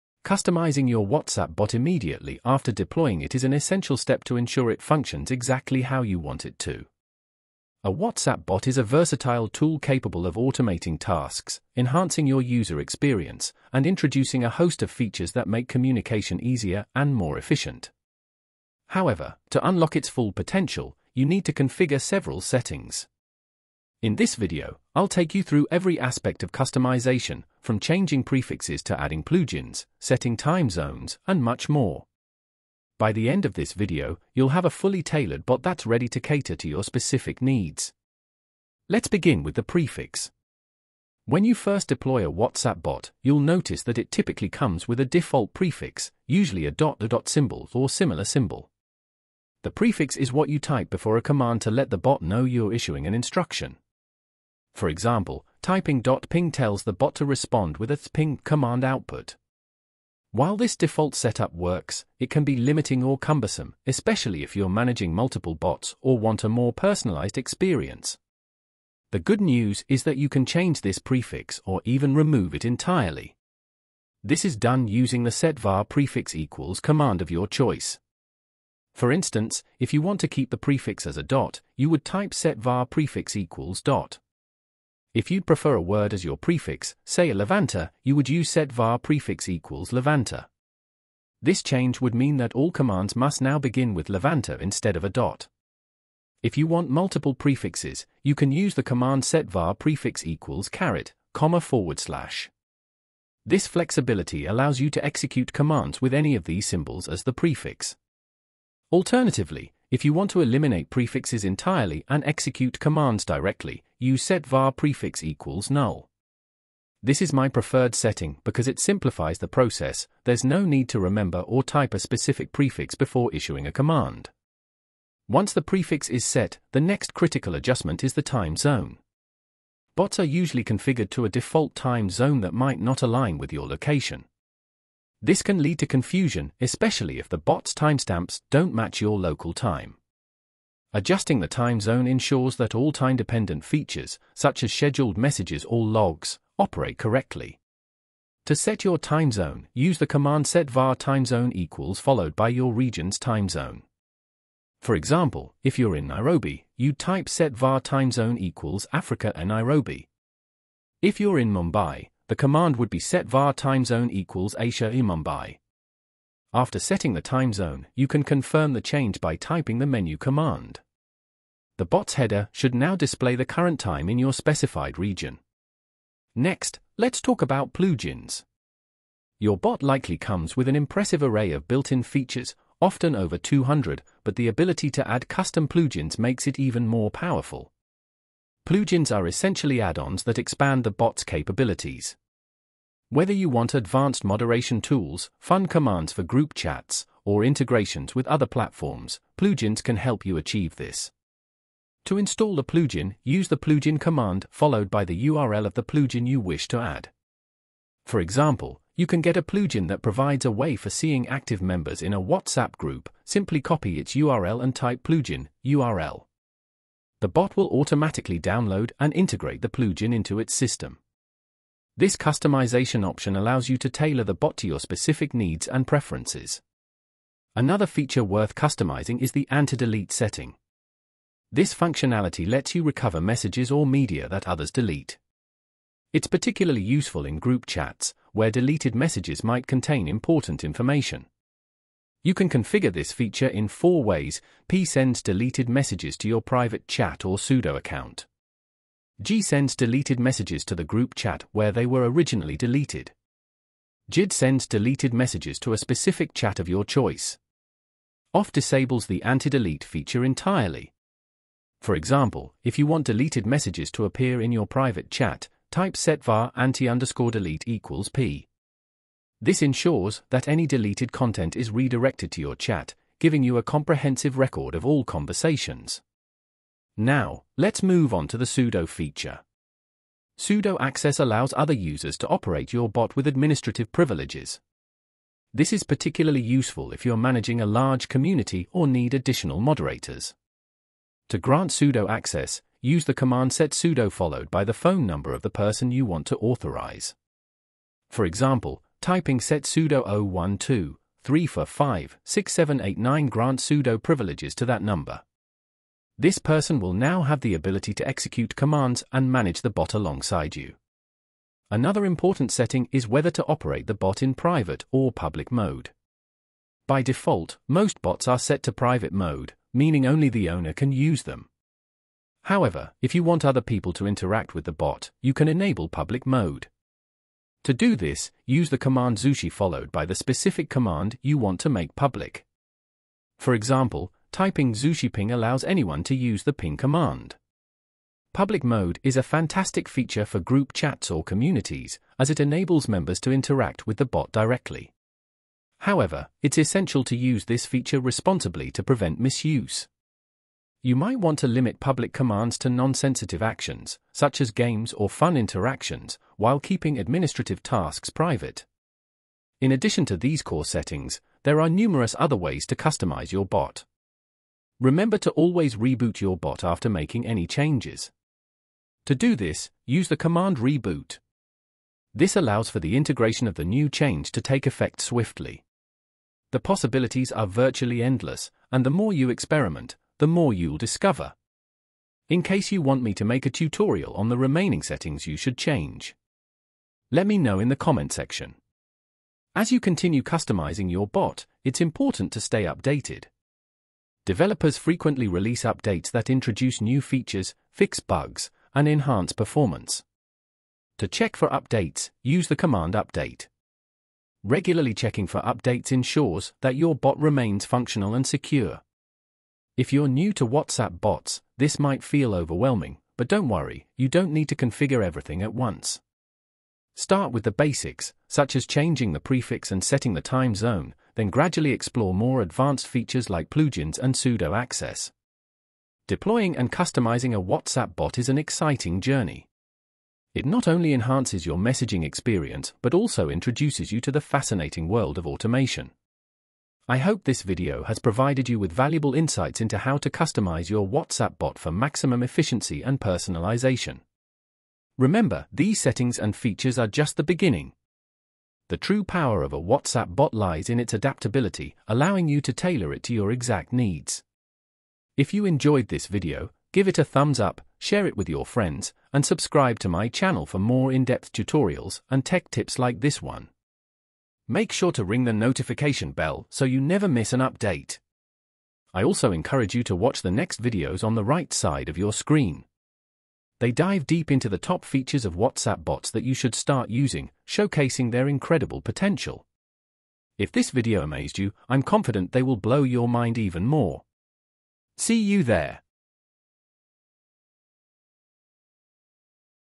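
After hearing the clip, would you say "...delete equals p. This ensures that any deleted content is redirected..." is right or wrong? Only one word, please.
right.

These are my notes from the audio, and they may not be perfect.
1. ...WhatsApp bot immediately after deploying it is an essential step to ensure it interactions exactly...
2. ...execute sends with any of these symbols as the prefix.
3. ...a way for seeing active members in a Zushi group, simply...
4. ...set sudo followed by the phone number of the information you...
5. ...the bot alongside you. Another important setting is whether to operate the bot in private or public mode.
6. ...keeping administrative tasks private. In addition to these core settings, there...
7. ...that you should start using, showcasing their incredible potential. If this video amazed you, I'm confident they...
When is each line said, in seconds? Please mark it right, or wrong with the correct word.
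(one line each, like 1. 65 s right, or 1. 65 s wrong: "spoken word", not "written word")
1. 1 s wrong: "functions", not "interactions"
2. 105 s wrong: "commands", not "sends"
3. 210 s wrong: "WhatsApp", not "Zushi"
4. 293 s wrong: "person", not "information"
5. 309 s right
6. 356 s right
7. 476 s right.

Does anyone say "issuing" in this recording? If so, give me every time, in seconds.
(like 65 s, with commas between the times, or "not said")
52 s, 123 s.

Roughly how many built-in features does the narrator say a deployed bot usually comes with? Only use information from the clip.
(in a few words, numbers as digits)
over 200.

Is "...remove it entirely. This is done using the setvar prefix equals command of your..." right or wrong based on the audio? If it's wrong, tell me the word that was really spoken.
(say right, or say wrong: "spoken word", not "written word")
right.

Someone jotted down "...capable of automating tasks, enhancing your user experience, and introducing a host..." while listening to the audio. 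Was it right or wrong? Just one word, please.
right.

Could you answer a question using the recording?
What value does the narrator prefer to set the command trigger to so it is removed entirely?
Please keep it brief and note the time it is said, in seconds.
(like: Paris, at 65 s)
null, at 115 s.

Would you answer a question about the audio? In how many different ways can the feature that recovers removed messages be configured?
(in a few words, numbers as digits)
4.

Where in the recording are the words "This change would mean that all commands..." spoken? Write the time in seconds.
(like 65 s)
91 s.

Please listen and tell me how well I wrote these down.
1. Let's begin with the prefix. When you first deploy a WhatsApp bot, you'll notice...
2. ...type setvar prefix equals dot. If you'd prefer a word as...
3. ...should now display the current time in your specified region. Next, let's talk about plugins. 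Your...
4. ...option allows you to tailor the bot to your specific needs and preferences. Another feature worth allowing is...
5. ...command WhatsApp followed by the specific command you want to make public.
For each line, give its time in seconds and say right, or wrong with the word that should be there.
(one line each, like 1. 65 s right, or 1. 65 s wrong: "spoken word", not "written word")
1. 38 s right
2. 82 s right
3. 172 s right
4. 223 s wrong: "customizing", not "allowing"
5. 328 s wrong: "Zushi", not "WhatsApp".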